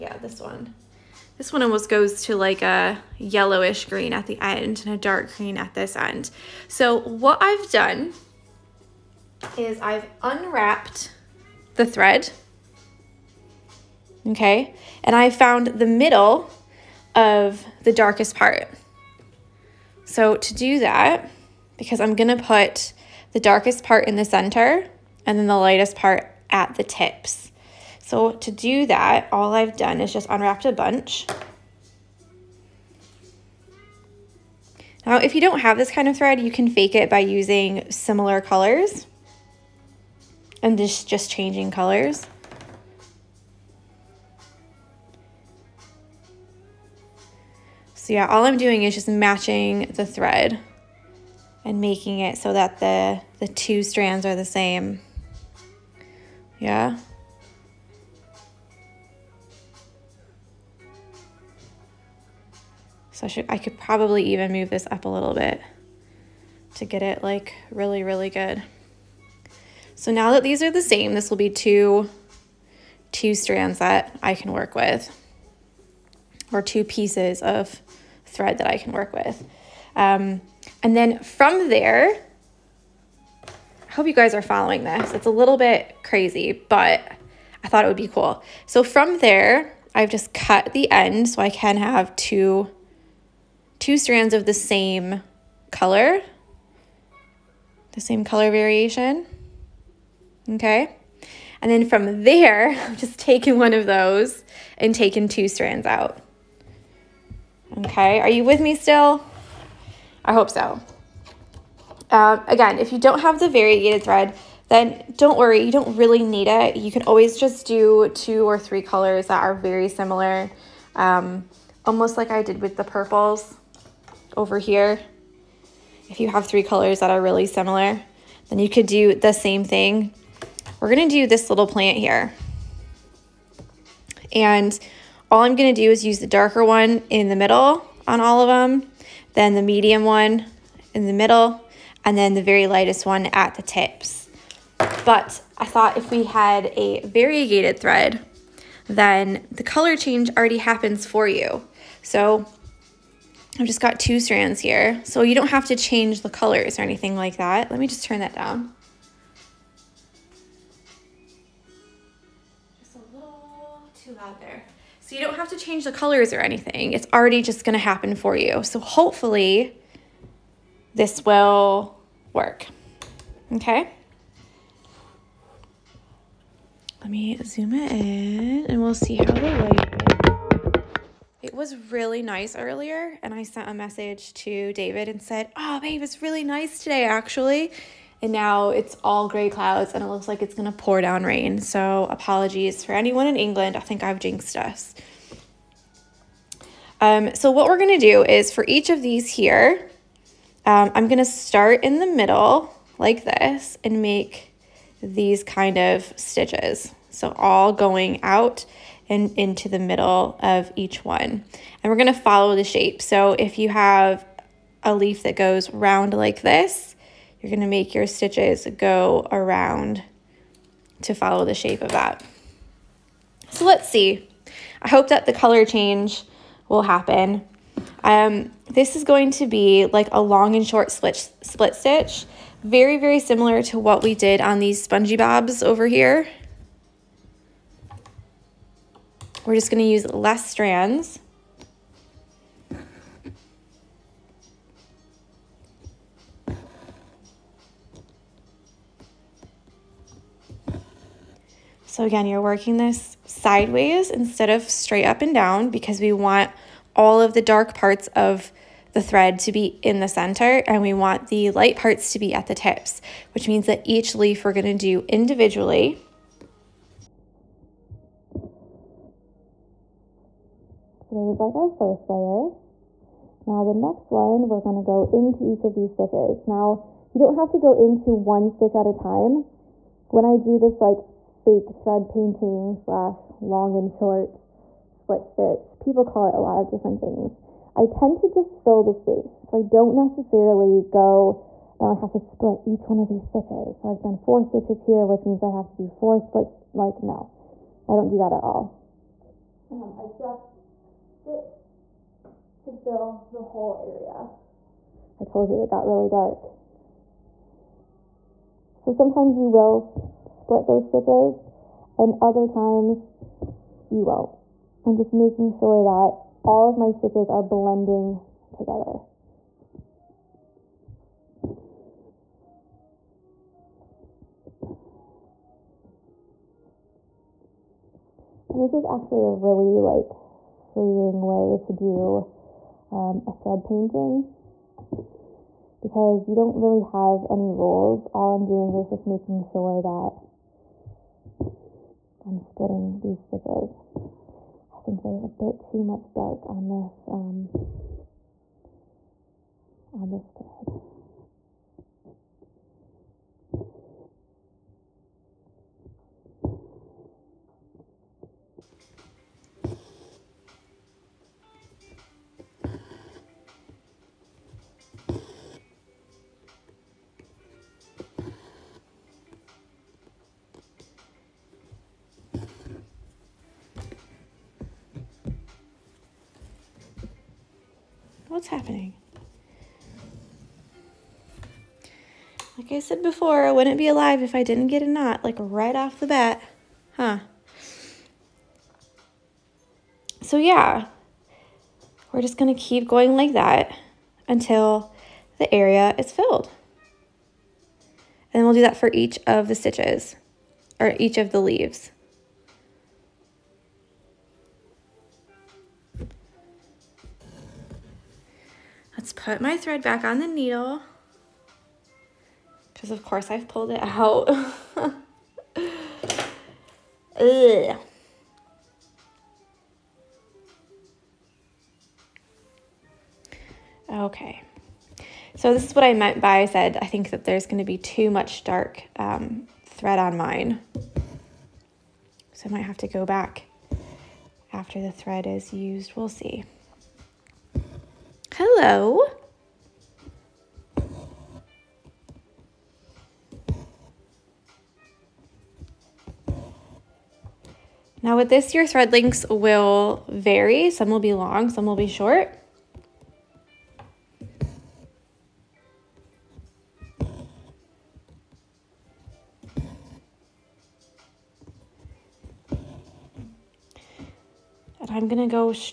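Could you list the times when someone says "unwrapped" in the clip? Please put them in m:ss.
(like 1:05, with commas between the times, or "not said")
0:10, 0:30.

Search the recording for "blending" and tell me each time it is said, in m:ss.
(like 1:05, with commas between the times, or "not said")
5:17.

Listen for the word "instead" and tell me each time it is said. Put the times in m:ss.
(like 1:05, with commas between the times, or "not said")
4:14.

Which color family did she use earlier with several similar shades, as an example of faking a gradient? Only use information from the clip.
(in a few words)
purples.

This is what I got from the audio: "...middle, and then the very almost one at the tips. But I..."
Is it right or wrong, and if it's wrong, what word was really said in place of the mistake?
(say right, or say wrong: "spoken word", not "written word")
wrong: "lightest", not "almost".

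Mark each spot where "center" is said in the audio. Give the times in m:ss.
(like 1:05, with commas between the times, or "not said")
0:24, 4:20.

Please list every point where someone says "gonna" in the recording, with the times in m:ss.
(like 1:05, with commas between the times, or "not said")
0:22, 4:24, 4:34.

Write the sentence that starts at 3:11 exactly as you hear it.
So, apologies for anyone in England.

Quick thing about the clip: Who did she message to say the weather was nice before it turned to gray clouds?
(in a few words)
David.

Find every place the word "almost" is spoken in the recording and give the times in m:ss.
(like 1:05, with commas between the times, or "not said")
0:01, 2:01.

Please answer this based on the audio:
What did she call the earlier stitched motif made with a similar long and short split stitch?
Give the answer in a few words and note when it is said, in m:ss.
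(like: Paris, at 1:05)
spongy bobs, at 3:54.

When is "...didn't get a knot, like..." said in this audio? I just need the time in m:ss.
6:24.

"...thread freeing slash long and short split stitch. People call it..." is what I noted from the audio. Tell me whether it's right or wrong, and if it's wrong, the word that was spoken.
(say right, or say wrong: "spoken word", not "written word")
wrong: "painting", not "freeing".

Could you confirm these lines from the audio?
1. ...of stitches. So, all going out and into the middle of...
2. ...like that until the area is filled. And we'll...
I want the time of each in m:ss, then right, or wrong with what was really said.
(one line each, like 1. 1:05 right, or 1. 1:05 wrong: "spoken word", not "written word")
1. 3:25 right
2. 6:33 right.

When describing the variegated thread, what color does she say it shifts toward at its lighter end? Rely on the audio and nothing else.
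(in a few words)
yellowish green.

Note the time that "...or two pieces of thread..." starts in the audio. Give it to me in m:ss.
1:16.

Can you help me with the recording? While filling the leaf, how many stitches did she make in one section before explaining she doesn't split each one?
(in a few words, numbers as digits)
4.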